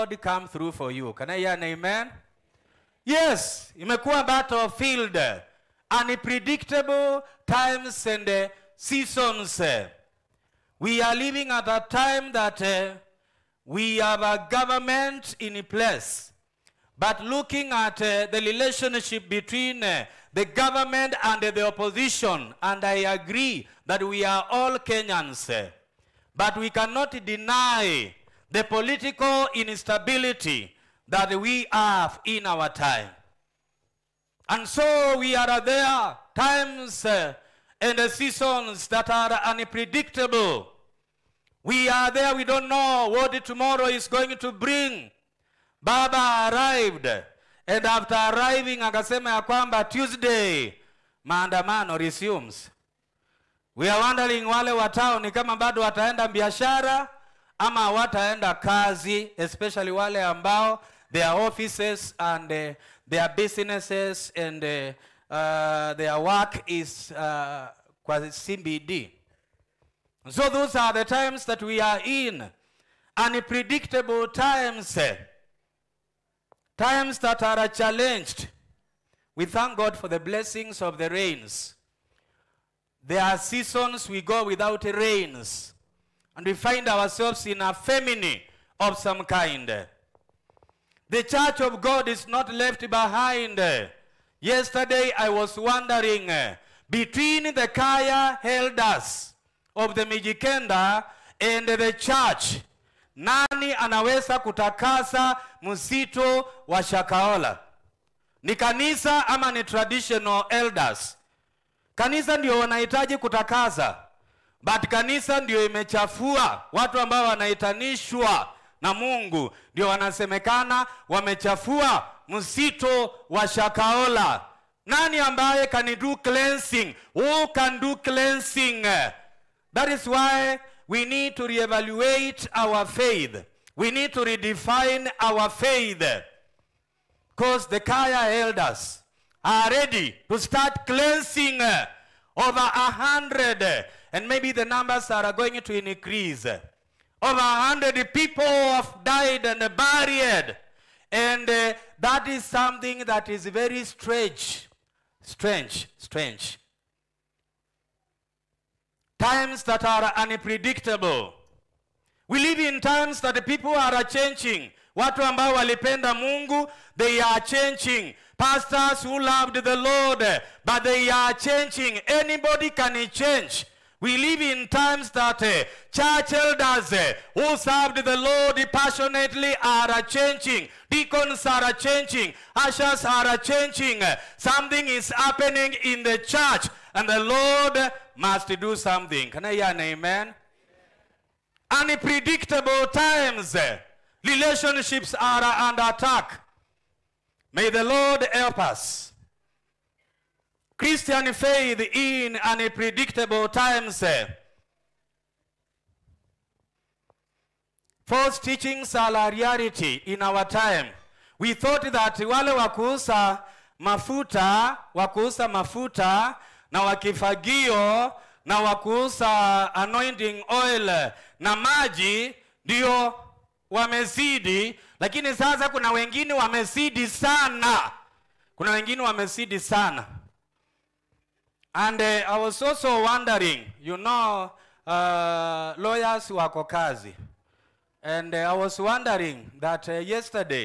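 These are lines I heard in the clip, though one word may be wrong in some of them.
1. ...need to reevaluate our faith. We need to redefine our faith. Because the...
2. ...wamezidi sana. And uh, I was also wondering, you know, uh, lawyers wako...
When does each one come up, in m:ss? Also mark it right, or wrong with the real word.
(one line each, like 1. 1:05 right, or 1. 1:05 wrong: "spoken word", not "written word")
1. 2:11 right
2. 3:49 right.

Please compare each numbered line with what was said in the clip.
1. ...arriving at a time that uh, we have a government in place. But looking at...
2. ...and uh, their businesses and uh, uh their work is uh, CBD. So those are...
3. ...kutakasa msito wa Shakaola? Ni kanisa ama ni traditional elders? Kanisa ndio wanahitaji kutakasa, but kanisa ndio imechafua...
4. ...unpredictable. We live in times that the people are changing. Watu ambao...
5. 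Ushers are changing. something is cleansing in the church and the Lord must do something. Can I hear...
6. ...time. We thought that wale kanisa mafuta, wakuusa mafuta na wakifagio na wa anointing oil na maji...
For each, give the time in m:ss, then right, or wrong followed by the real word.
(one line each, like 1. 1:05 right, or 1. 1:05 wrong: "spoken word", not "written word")
1. 0:11 wrong: "living", not "arriving"
2. 1:02 right
3. 1:44 right
4. 2:40 right
5. 3:02 wrong: "happening", not "cleansing"
6. 3:30 wrong: "wakuusa", not "kanisa".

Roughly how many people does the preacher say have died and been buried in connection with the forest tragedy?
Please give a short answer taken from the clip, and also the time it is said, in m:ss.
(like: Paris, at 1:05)
Over 100, at 2:27.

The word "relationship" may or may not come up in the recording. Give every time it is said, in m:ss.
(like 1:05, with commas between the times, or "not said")
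0:18, 3:14.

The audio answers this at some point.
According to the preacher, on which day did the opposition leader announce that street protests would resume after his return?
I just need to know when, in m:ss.
0:49.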